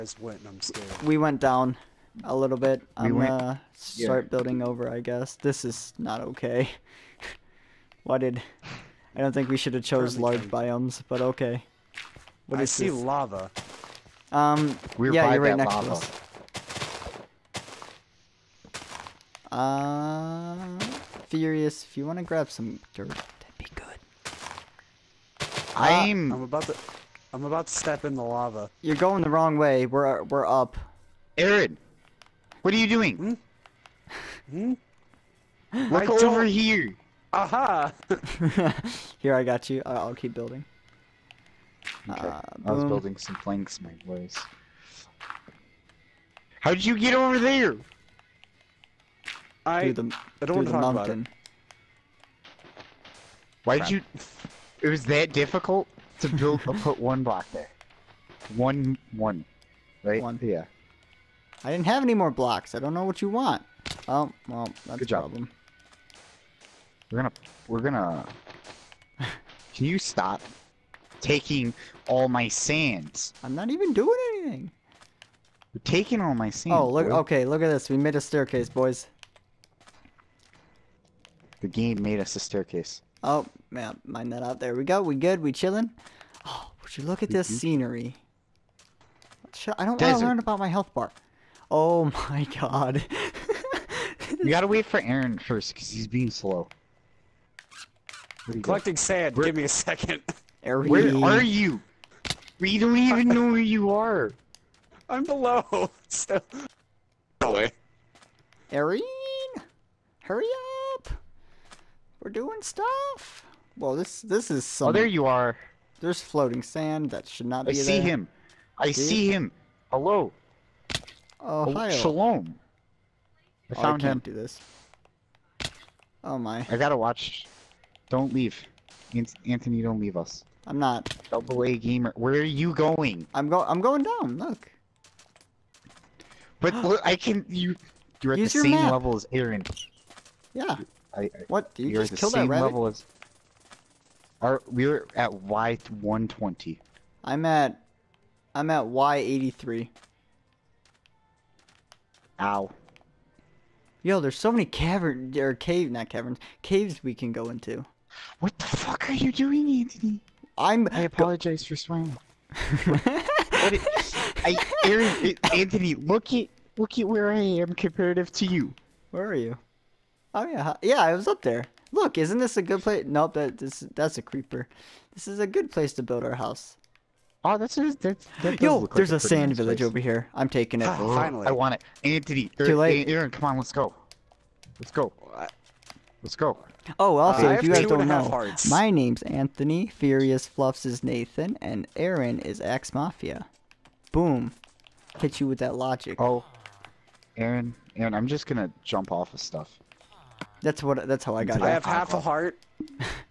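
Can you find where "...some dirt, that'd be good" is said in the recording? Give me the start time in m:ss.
0:22.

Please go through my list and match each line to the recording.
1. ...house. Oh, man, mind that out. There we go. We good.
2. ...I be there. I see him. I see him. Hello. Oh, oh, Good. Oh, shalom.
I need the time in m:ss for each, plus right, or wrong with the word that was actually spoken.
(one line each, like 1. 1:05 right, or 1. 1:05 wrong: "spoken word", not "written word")
1. 1:22 wrong: "staircase", not "house"
2. 1:57 wrong: "Ohio", not "Good".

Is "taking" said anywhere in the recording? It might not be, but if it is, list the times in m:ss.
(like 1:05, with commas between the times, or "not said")
1:11, 1:15, 3:00.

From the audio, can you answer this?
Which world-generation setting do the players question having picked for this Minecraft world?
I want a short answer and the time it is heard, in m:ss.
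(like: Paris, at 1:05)
Large biomes, at 0:10.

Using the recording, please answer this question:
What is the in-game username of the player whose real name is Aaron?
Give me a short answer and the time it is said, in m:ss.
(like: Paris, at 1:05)
Axe Mafia, at 3:12.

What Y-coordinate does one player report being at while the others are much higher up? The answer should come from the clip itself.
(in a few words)
Y83.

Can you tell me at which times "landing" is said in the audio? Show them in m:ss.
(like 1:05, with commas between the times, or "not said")
not said.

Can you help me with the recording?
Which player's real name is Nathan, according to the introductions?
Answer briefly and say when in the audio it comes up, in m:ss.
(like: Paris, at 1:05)
Furious Fluffs, at 3:09.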